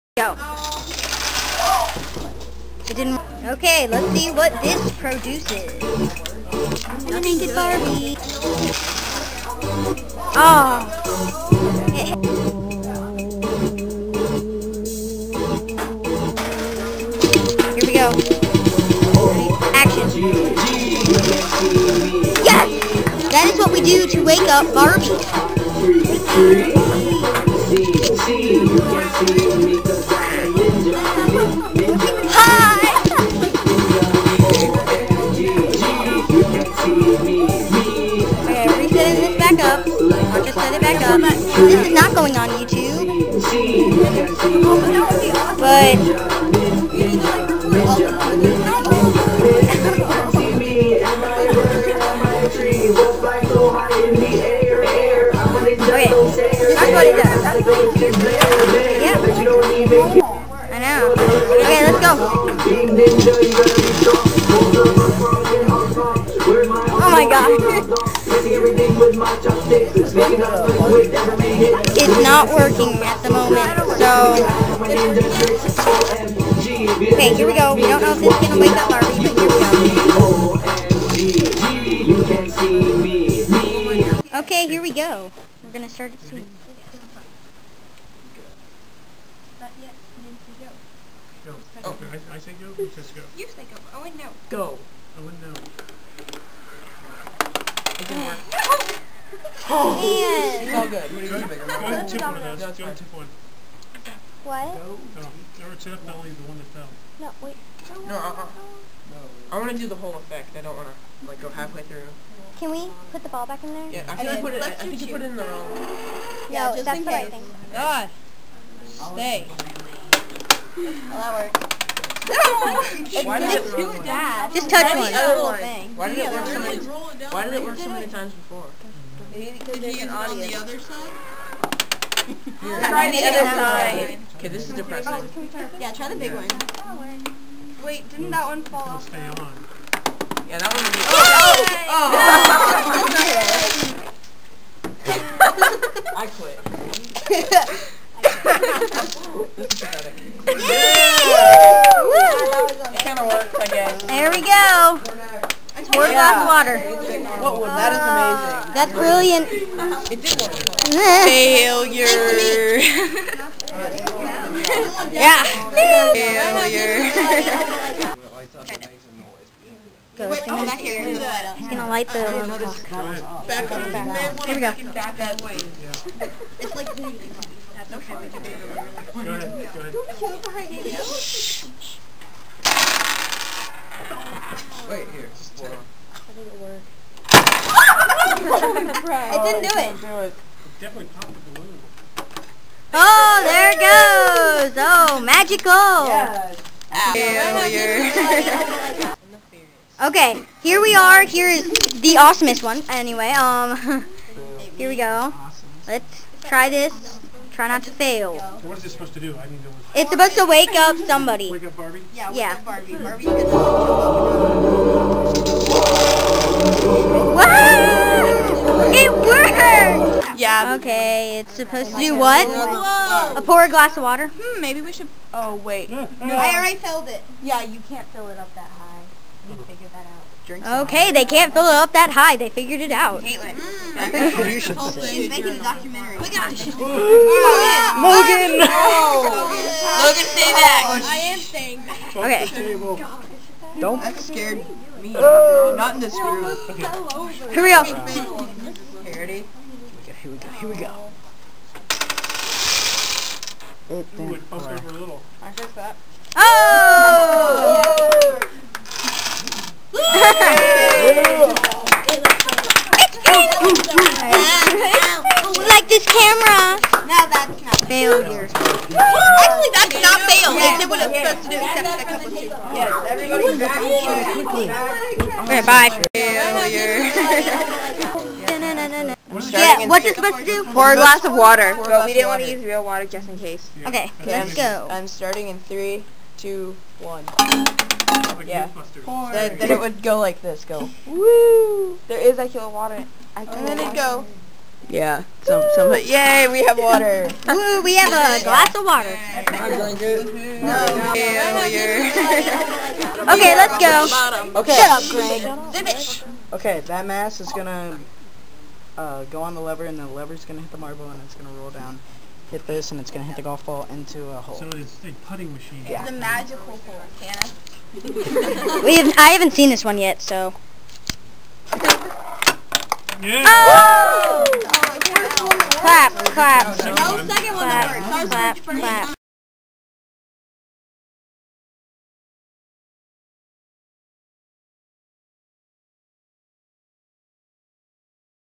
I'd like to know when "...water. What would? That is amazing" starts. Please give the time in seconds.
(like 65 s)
156 s.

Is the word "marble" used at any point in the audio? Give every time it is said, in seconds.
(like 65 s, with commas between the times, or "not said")
310 s.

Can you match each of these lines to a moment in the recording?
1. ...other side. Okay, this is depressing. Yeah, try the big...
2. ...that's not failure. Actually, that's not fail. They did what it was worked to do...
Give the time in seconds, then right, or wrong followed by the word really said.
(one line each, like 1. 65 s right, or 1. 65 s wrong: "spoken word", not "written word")
1. 133 s right
2. 267 s wrong: "supposed", not "worked".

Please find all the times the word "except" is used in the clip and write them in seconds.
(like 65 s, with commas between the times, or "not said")
271 s.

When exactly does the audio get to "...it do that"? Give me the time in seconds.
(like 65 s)
123 s.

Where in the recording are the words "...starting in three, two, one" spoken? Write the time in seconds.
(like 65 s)
285 s.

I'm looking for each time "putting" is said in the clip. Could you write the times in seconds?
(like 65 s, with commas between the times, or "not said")
315 s.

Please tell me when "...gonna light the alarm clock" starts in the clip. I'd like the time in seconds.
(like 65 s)
171 s.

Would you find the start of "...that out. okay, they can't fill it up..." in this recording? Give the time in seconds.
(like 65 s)
229 s.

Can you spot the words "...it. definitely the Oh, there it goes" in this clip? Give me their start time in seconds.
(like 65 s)
190 s.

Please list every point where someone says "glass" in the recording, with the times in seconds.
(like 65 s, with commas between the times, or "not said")
223 s, 280 s, 298 s.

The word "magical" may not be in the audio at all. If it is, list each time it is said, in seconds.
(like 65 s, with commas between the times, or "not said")
195 s, 316 s.